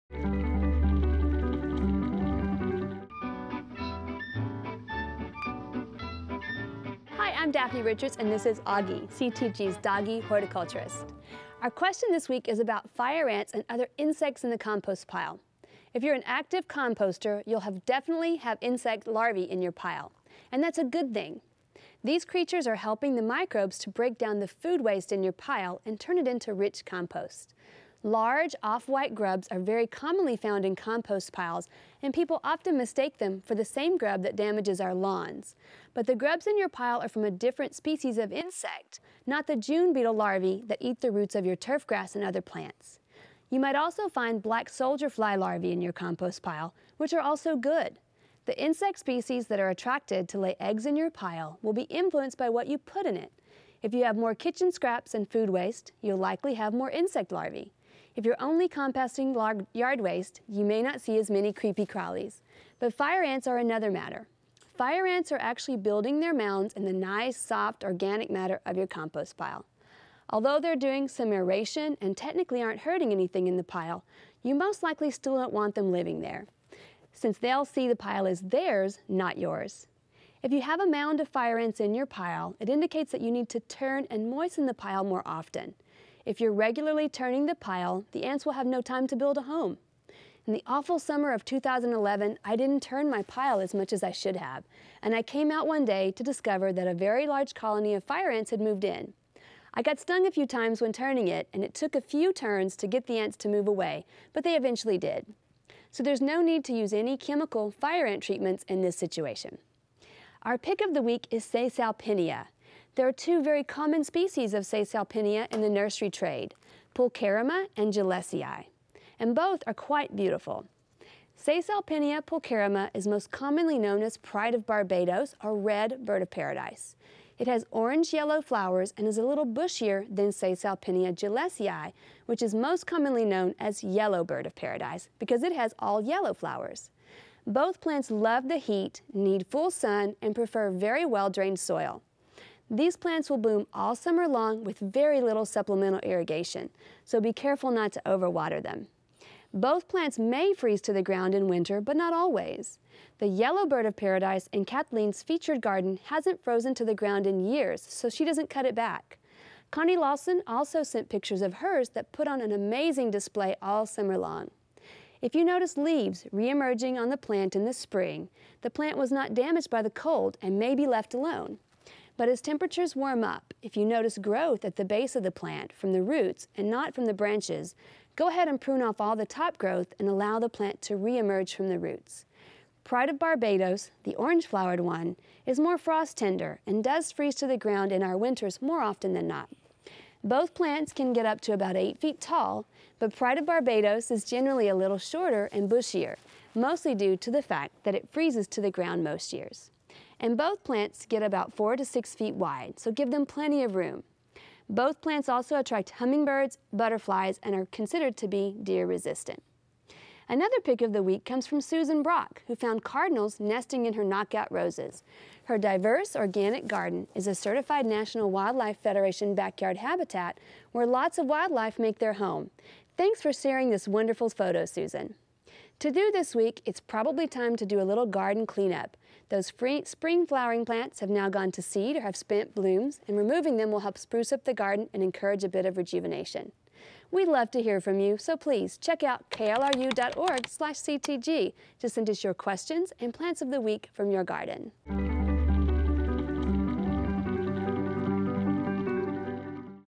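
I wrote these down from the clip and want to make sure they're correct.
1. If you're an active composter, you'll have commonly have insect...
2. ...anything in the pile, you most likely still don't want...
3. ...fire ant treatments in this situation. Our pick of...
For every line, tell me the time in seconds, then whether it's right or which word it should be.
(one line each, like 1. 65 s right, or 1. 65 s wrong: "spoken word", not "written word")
1. 15 s wrong: "definitely", not "commonly"
2. 73 s right
3. 107 s right.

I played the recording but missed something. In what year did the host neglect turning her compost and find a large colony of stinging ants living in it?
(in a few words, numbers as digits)
2011.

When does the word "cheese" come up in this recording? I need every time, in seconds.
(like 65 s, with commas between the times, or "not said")
not said.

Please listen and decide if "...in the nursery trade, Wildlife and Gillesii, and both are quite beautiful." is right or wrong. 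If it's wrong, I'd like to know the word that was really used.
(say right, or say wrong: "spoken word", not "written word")
wrong: "Pulcherrima", not "Wildlife".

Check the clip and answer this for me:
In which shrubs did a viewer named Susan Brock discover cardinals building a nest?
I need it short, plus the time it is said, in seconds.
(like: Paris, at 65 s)
Knockout roses, at 214 s.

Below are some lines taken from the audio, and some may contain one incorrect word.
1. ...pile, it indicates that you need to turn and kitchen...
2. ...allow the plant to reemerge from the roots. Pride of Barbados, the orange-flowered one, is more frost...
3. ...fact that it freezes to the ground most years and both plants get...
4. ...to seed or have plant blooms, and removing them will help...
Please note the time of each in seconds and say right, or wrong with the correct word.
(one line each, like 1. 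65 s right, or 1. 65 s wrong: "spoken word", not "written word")
1. 82 s wrong: "moisten", not "kitchen"
2. 180 s right
3. 197 s right
4. 231 s wrong: "spent", not "plant".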